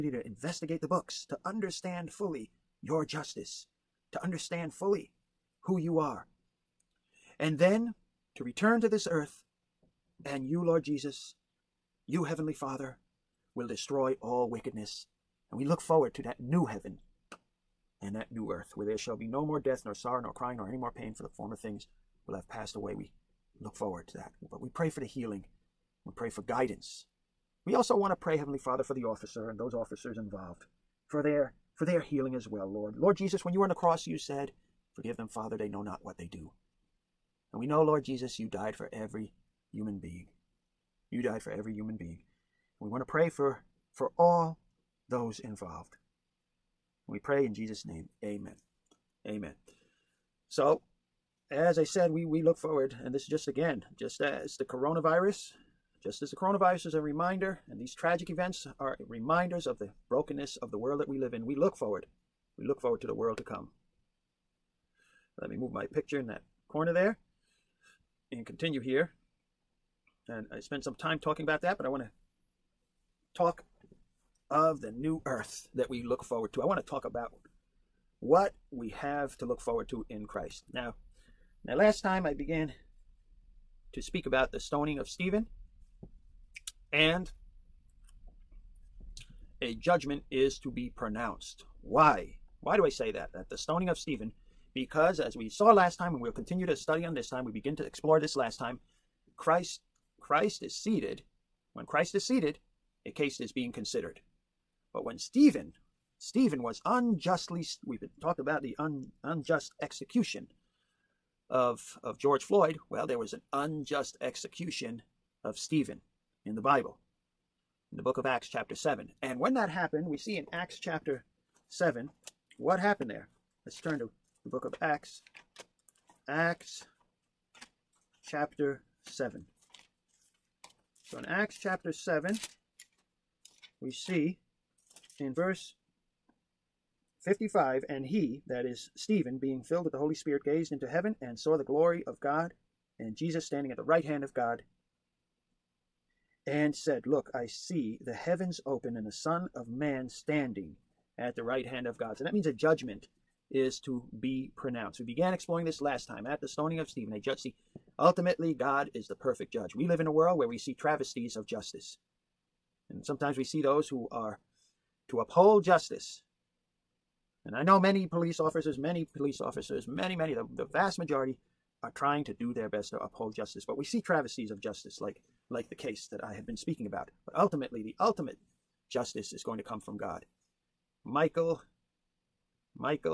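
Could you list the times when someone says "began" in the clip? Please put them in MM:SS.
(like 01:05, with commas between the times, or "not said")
01:22, 02:35.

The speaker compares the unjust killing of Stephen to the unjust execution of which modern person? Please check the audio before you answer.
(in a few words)
George Floyd.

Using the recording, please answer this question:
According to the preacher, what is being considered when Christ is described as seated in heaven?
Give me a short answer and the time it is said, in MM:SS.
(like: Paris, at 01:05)
A case, at 01:43.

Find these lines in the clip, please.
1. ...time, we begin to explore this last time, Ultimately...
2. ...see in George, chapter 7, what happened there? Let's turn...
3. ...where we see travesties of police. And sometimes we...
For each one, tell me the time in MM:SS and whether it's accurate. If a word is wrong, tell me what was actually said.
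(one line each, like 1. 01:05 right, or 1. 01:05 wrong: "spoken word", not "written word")
1. 01:37 wrong: "Christ", not "Ultimately"
2. 02:00 wrong: "Acts", not "George"
3. 02:40 wrong: "justice", not "police".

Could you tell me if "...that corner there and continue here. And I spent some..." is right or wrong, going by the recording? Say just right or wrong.
right.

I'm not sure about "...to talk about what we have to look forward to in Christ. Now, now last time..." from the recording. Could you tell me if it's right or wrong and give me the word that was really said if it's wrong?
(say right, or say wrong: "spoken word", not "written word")
right.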